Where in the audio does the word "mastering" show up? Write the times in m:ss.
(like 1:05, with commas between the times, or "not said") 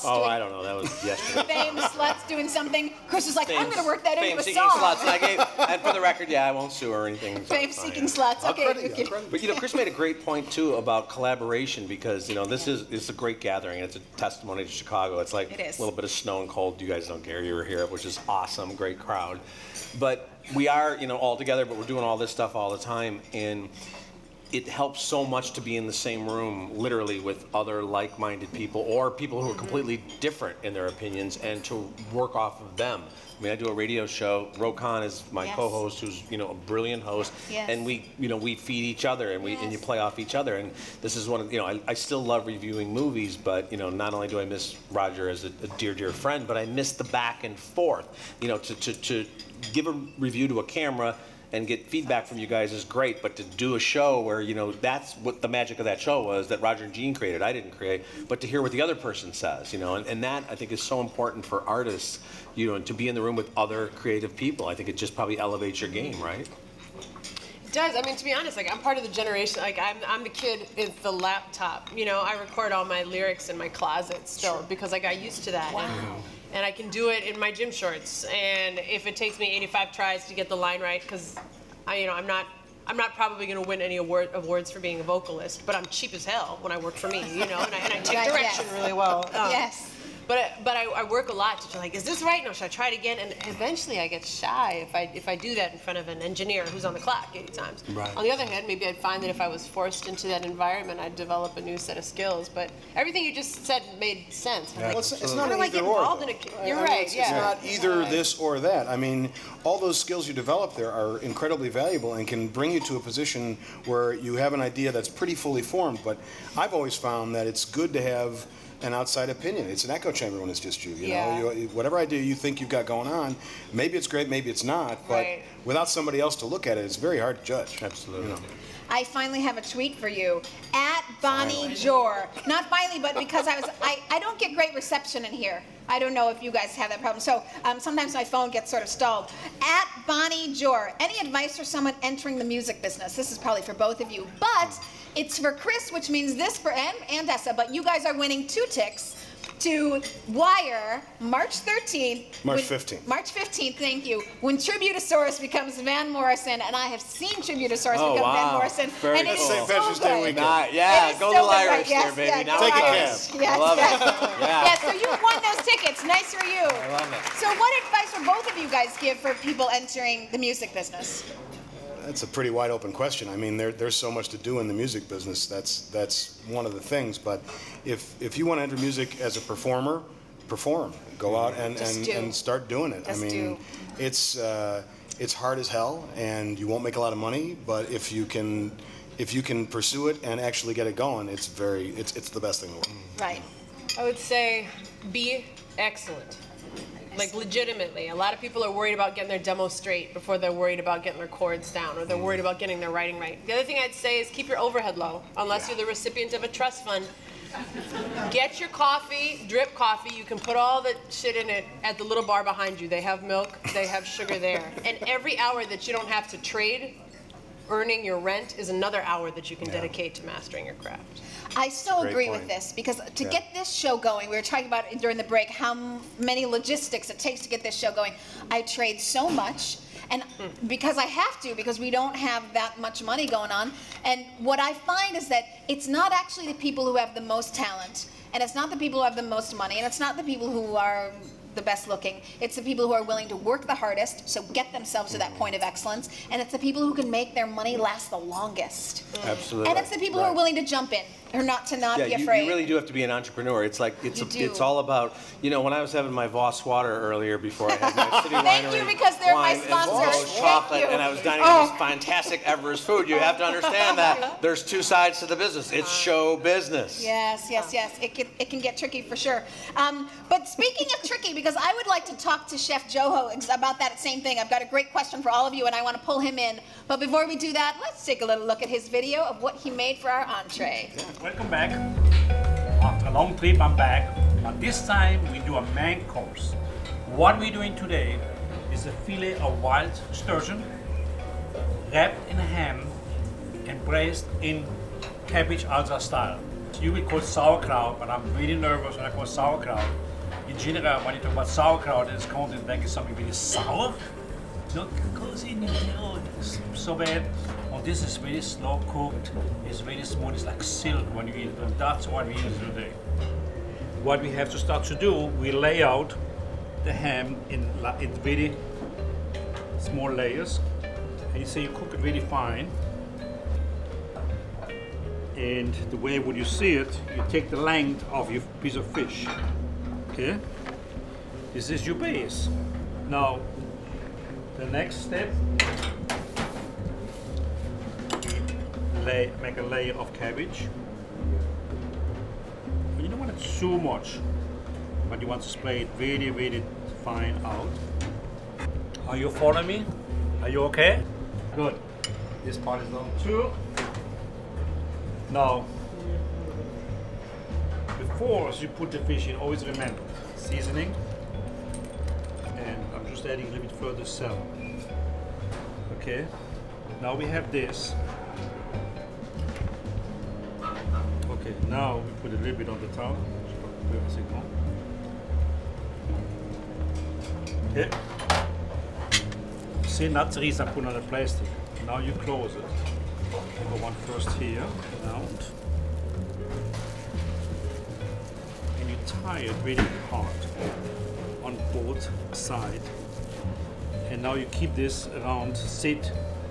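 3:40.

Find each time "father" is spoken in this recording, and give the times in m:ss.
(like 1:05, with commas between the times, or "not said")
not said.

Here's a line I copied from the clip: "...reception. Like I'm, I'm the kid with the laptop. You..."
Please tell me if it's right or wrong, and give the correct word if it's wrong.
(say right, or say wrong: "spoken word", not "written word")
wrong: "generation", not "reception".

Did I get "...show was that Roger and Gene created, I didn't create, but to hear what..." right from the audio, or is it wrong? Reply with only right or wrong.
right.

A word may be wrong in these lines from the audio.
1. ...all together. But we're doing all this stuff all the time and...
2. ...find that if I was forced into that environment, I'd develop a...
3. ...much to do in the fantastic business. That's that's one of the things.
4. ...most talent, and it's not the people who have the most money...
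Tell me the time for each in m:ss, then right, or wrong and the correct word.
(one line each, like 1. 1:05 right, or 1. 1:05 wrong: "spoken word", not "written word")
1. 0:21 right
2. 1:38 right
3. 2:54 wrong: "music", not "fantastic"
4. 3:57 right.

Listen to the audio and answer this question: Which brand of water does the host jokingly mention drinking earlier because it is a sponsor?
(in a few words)
Voss.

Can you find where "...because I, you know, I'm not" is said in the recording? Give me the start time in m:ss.
1:21.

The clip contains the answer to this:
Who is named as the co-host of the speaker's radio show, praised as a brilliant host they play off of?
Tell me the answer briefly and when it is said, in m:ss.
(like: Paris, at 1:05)
Roe Conn, at 0:34.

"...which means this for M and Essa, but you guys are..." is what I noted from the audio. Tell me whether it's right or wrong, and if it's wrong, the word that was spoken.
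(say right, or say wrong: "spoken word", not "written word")
right.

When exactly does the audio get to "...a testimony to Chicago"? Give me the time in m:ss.
0:13.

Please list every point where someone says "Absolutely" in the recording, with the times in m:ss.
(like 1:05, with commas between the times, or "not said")
2:07, 4:09.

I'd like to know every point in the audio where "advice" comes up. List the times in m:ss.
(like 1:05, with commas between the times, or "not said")
2:21, 2:47.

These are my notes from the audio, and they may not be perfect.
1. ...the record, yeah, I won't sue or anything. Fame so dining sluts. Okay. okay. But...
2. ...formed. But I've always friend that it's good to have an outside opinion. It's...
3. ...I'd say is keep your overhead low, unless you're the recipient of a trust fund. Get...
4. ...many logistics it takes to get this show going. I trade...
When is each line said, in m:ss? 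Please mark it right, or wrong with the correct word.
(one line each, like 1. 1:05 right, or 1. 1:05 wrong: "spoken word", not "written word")
1. 0:05 wrong: "seeking", not "dining"
2. 1:55 wrong: "found", not "friend"
3. 3:23 right
4. 3:46 right.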